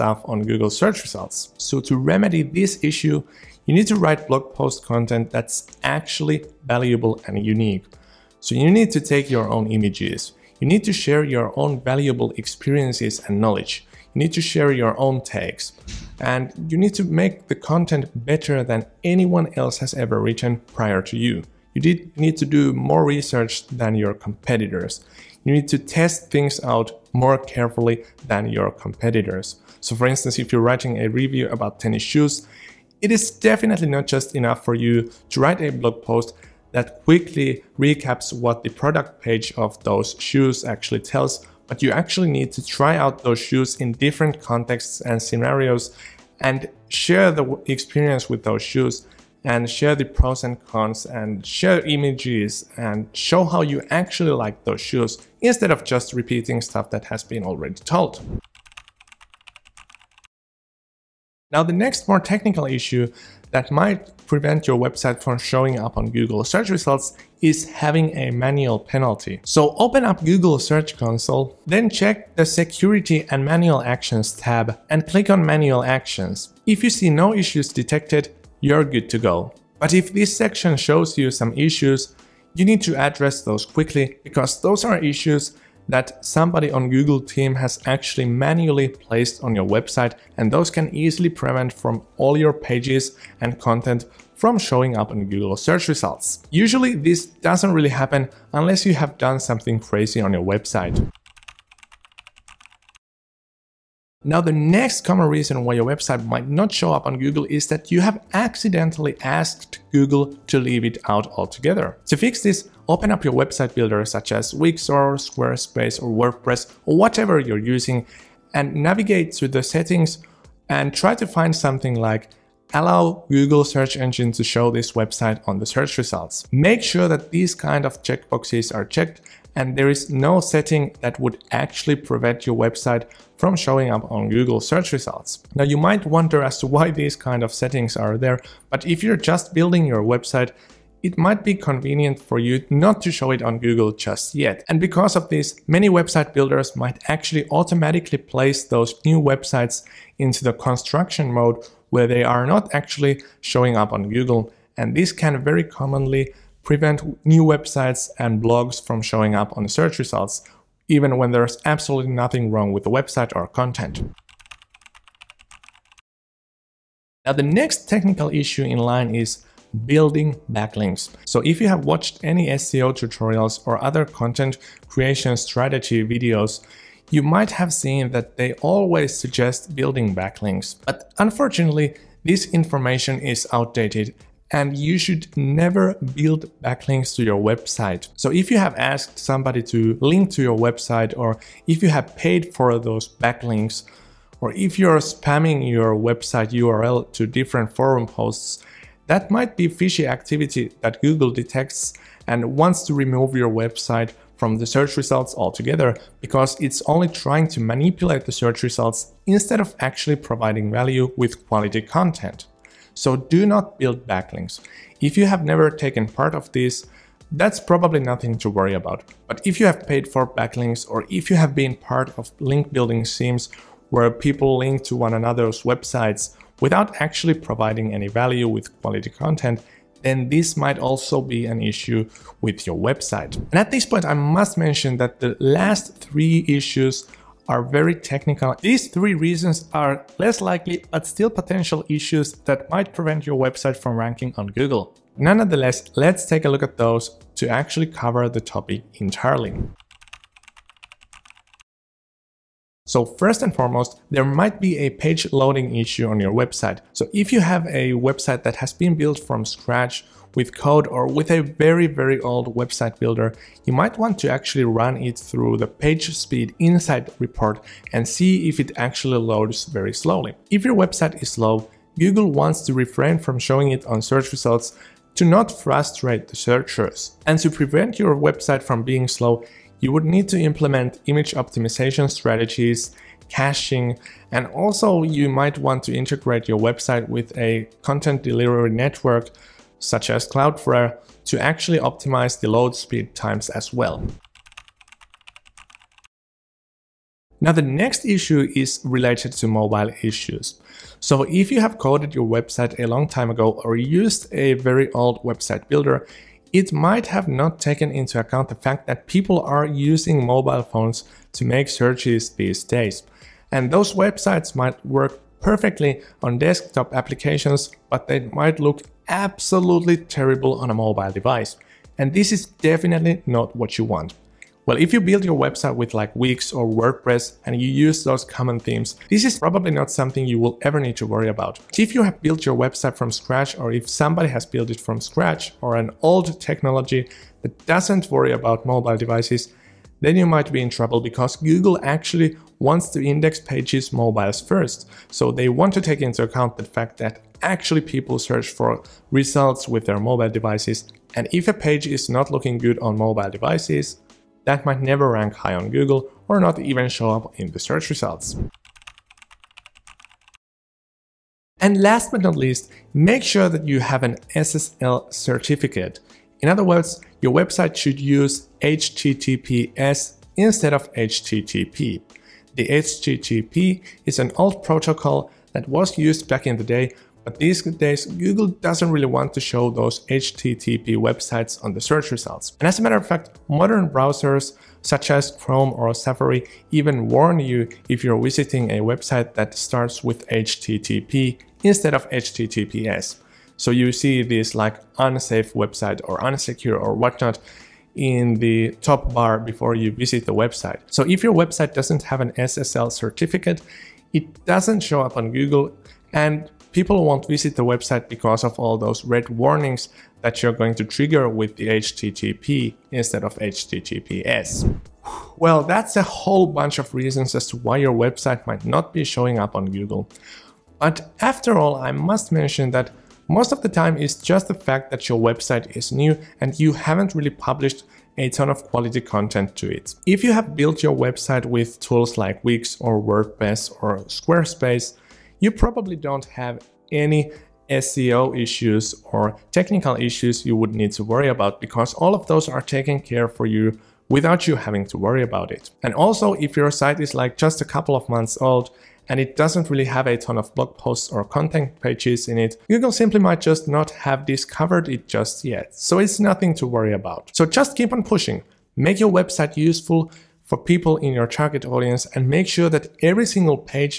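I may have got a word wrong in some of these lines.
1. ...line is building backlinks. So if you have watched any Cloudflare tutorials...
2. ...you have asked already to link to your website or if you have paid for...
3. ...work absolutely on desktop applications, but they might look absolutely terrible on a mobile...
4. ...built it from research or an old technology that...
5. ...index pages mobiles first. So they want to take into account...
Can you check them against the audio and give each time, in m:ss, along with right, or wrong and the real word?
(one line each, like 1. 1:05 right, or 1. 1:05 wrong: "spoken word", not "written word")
1. 2:48 wrong: "SEO", not "Cloudflare"
2. 3:08 wrong: "somebody", not "already"
3. 5:14 wrong: "perfectly", not "absolutely"
4. 5:34 wrong: "scratch", not "research"
5. 5:43 right.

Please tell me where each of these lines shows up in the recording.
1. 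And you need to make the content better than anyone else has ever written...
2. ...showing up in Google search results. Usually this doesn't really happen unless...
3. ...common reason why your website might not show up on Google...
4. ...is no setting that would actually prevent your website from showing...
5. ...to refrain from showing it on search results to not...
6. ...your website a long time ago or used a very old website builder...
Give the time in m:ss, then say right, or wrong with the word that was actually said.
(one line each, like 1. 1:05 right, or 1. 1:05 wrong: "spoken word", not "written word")
1. 0:16 right
2. 1:34 right
3. 1:45 right
4. 2:09 right
5. 4:32 right
6. 5:02 right.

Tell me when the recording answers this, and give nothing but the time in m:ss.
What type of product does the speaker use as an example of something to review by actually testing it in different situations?
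0:31.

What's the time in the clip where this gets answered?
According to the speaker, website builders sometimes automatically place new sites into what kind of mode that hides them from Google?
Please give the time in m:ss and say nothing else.
2:30.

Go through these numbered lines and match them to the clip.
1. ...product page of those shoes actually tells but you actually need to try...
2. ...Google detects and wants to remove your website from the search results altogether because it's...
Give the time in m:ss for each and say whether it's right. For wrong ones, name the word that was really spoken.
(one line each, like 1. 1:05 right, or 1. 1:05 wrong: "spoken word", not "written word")
1. 0:38 right
2. 3:21 right.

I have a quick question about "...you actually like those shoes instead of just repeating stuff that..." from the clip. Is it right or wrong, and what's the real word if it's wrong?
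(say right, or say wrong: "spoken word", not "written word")
right.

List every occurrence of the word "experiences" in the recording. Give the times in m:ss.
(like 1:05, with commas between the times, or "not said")
0:12, 0:47.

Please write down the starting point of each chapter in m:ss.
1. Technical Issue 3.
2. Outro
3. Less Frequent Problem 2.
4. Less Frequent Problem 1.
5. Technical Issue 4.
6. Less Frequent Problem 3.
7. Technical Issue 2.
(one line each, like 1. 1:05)
1. 1:40
2. 6:54
3. 4:54
4. 4:09
5. 2:42
6. 5:58
7. 0:57.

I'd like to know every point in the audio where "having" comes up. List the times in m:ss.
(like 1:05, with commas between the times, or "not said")
1:07, 7:24.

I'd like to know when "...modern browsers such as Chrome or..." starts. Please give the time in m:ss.
6:23.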